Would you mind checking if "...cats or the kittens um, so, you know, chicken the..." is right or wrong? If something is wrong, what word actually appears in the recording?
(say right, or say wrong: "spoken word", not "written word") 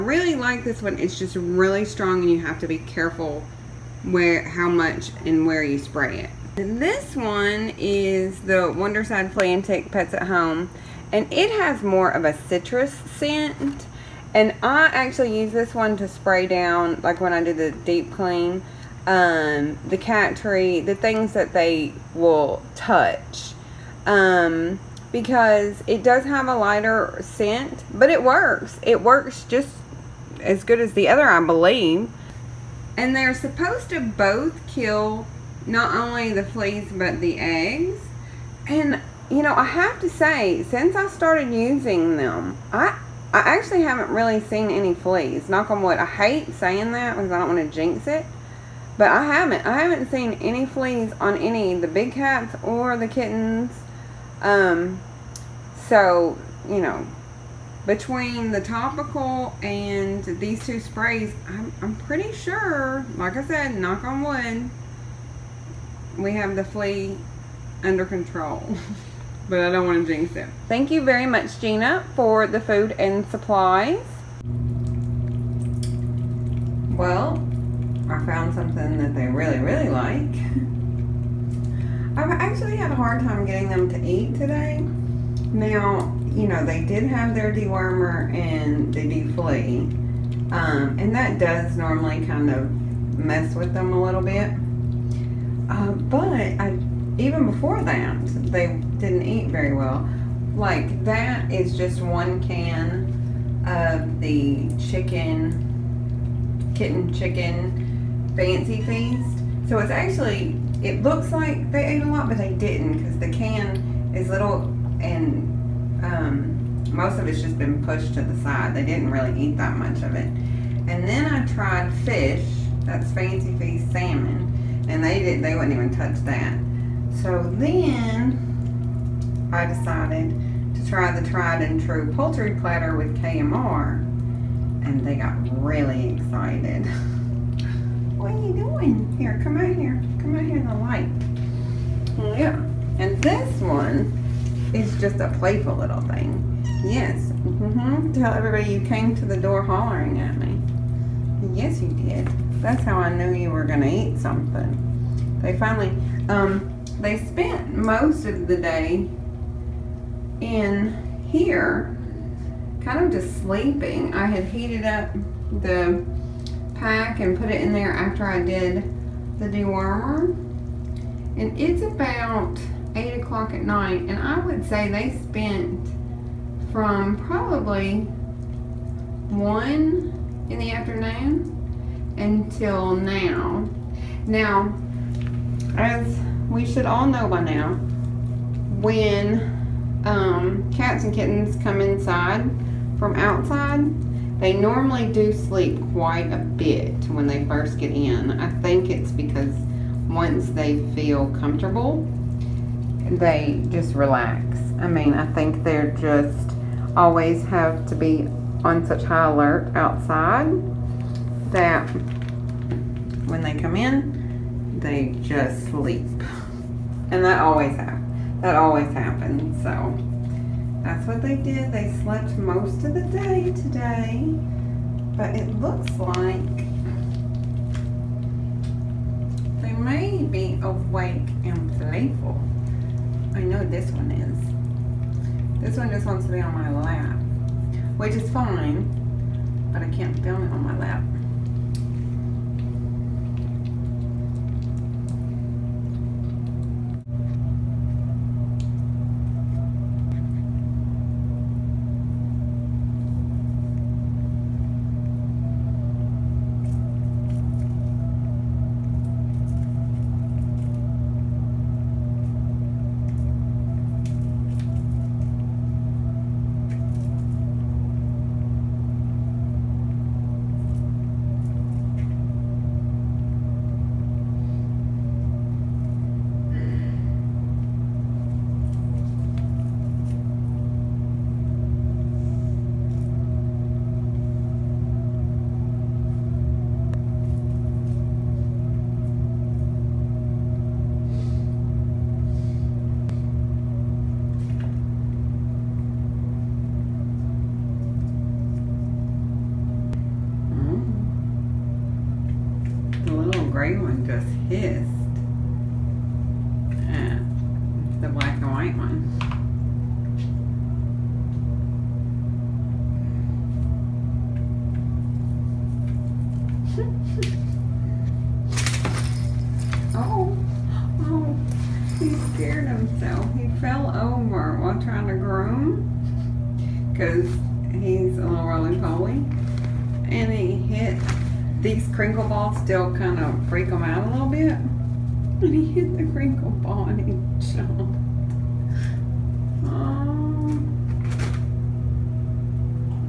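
wrong: "between", not "chicken".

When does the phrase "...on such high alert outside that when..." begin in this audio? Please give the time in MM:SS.
03:28.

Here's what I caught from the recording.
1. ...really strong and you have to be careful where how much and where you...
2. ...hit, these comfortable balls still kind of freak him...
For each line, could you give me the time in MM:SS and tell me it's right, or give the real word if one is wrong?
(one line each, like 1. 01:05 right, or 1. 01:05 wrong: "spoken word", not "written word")
1. 00:01 right
2. 05:30 wrong: "crinkle", not "comfortable".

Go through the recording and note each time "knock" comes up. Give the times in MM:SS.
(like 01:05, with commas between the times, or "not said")
00:45, 01:03.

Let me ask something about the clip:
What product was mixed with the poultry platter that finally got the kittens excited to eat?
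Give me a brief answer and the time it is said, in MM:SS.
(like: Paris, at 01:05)
KMR, at 02:13.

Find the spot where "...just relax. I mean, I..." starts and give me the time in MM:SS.
03:23.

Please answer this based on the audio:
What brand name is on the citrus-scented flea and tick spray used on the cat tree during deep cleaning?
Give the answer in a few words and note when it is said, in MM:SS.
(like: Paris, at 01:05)
Wondercide, at 00:08.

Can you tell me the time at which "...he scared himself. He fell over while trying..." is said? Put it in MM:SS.
05:22.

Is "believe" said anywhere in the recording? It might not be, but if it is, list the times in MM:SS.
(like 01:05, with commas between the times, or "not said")
00:31.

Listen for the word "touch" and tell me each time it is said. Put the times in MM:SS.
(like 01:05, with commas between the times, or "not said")
00:22, 02:05.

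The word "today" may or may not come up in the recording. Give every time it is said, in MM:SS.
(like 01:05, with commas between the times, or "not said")
01:24, 03:43.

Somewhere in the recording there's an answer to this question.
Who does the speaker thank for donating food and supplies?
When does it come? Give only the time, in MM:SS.
01:11.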